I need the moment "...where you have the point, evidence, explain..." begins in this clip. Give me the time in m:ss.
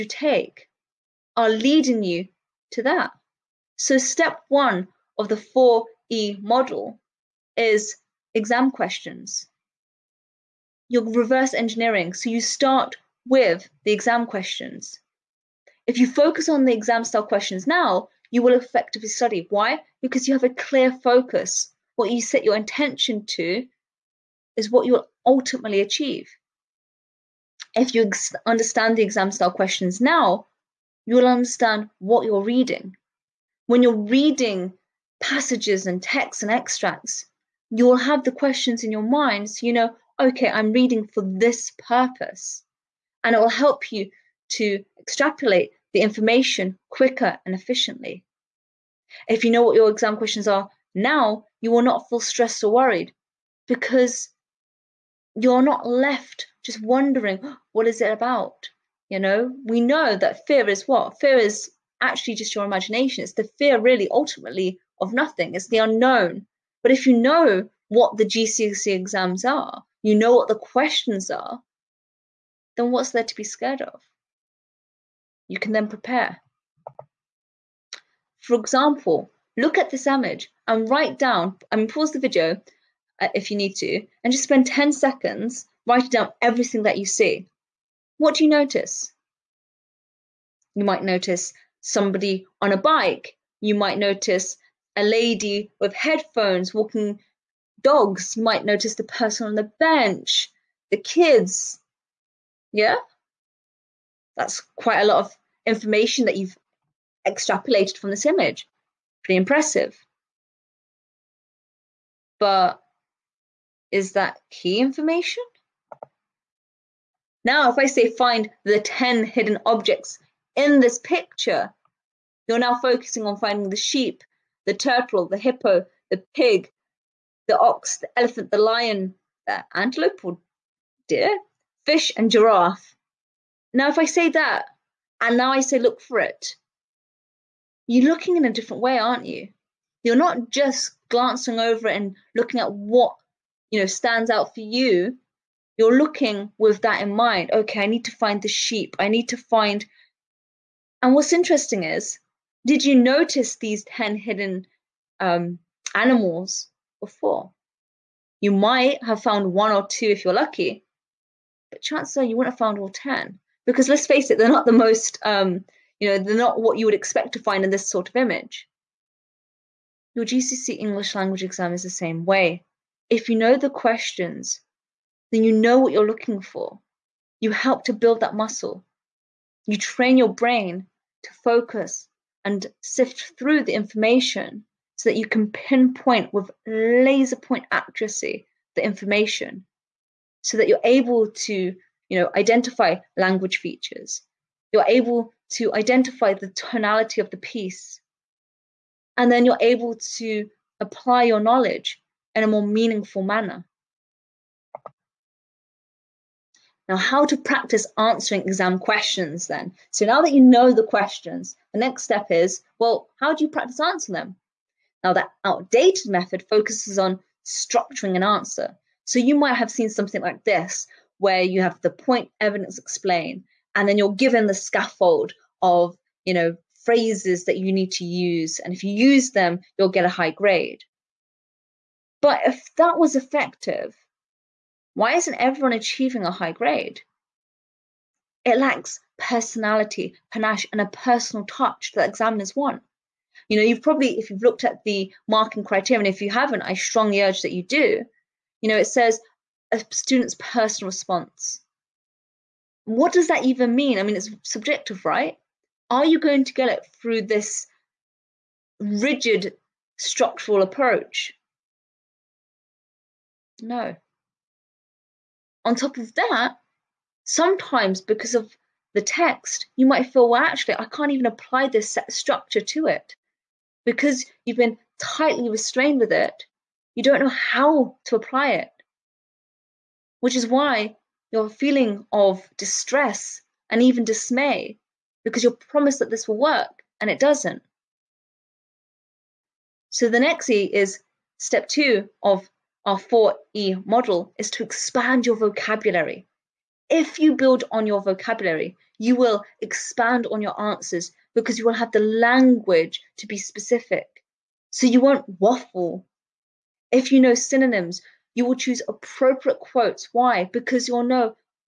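3:41.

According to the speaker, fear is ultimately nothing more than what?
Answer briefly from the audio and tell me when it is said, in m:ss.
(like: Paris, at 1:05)
Your imagination, at 1:02.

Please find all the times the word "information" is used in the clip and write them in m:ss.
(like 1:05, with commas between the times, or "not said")
0:46, 1:45, 1:54, 3:03, 3:08.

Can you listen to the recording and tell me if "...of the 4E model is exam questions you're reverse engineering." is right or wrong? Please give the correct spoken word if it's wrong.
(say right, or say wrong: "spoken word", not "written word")
right.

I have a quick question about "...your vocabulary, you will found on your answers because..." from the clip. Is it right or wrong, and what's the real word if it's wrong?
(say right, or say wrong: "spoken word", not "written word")
wrong: "expand", not "found".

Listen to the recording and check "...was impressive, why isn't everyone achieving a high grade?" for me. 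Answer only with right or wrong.
wrong.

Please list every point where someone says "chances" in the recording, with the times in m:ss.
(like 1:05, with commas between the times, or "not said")
2:41.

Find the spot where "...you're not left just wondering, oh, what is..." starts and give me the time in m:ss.
0:55.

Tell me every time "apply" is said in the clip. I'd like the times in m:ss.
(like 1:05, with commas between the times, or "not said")
3:20, 4:31, 4:38.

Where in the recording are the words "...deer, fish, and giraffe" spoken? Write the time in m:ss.
2:11.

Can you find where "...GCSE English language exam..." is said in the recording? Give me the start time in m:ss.
2:50.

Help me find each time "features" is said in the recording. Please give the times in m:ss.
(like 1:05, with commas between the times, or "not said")
3:13.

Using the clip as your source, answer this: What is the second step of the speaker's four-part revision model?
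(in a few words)
Expand your vocabulary.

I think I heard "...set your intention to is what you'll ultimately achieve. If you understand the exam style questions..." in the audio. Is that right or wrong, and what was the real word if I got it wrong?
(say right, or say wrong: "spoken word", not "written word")
right.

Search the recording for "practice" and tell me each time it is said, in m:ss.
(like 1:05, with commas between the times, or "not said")
3:27, 3:33.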